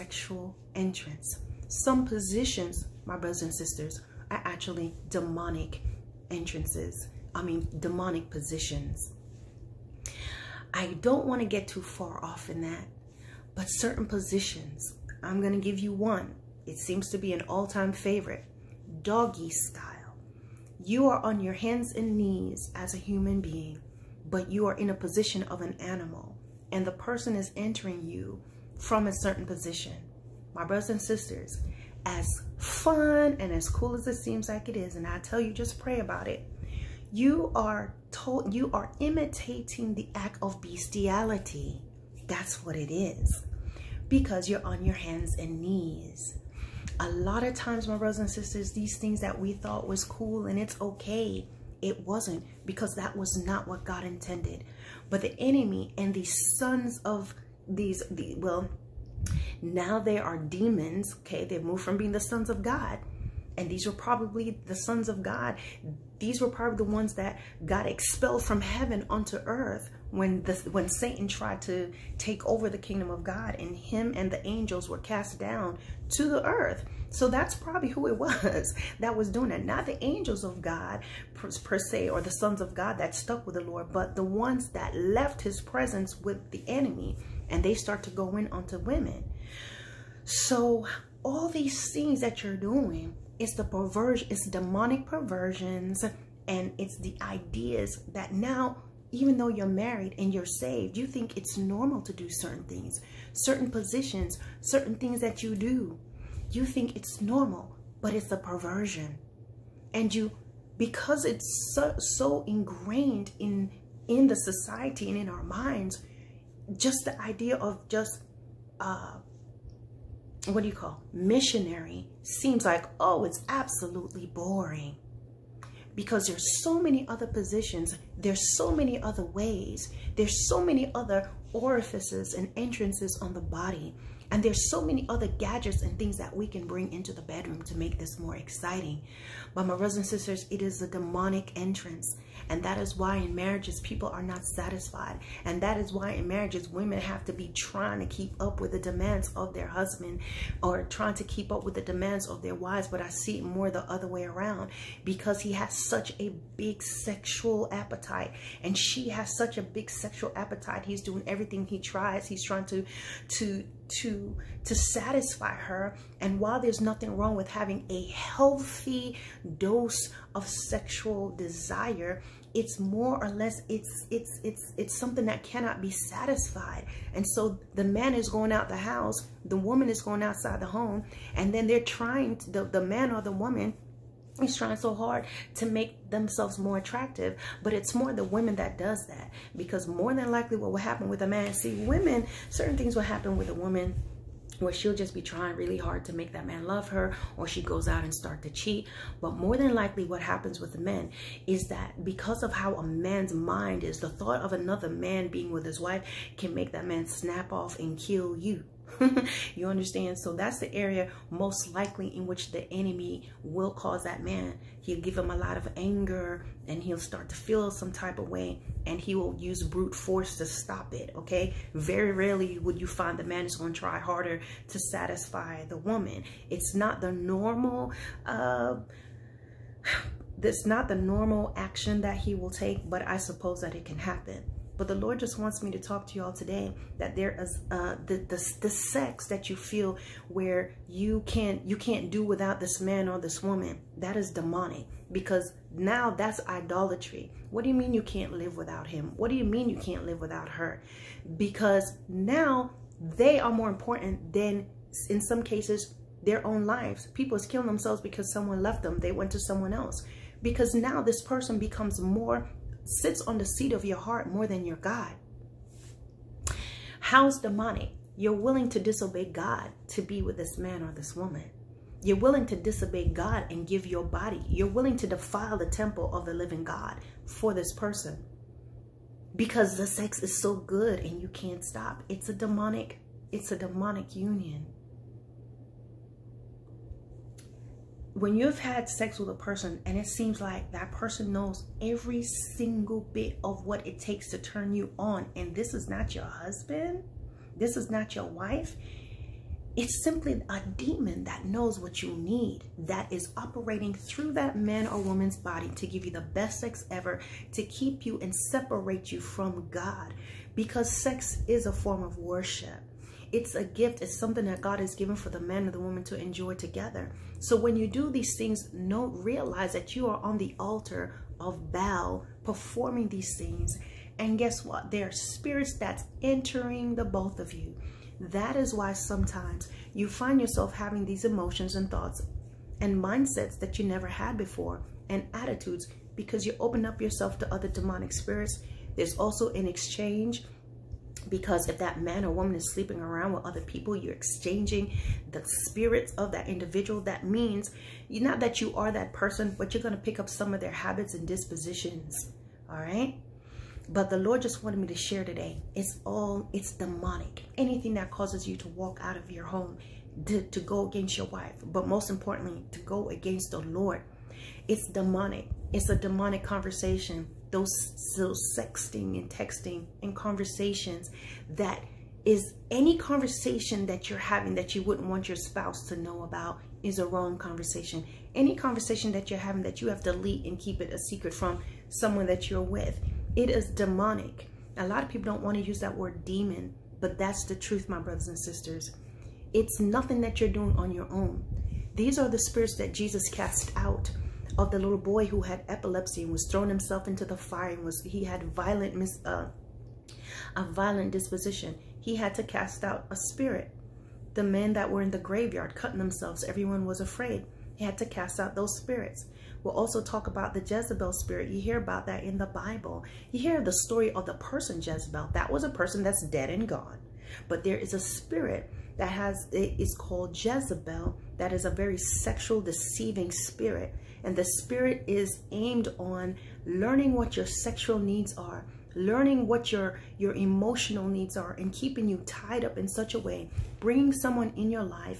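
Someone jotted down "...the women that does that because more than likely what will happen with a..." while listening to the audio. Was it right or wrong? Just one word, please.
right.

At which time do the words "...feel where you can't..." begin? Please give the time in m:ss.
3:59.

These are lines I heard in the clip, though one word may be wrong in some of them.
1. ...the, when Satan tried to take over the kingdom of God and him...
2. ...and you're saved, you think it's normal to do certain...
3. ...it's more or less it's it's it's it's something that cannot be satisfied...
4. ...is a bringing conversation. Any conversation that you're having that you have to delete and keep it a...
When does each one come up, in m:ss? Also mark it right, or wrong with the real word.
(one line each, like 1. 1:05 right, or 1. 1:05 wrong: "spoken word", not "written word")
1. 1:10 right
2. 1:40 right
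3. 2:52 right
4. 6:16 wrong: "wrong", not "bringing".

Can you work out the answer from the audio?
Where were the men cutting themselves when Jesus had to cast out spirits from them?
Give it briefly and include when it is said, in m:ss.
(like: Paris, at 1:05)
The graveyard, at 6:45.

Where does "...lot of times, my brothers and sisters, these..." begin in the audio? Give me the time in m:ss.
0:47.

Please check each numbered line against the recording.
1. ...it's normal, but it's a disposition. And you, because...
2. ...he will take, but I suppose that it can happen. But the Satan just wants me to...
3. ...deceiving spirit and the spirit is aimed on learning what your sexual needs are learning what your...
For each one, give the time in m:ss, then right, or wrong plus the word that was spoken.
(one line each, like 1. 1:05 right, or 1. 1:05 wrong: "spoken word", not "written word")
1. 1:46 wrong: "perversion", not "disposition"
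2. 3:52 wrong: "Lord", not "Satan"
3. 7:02 right.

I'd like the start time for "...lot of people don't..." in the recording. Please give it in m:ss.
6:24.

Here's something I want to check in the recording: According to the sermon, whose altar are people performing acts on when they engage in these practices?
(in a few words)
Baal.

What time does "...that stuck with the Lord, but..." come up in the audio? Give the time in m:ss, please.
1:22.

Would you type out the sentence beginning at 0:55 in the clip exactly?
But the enemy and the sons of these, the, well, now they are demons.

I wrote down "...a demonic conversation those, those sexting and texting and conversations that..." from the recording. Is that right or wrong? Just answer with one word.
right.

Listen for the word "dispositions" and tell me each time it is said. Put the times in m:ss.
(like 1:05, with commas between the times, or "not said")
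5:51, 6:41.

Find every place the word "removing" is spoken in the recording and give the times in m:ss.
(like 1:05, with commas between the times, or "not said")
not said.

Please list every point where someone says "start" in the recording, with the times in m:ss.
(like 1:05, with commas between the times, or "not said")
1:27, 3:18, 3:36.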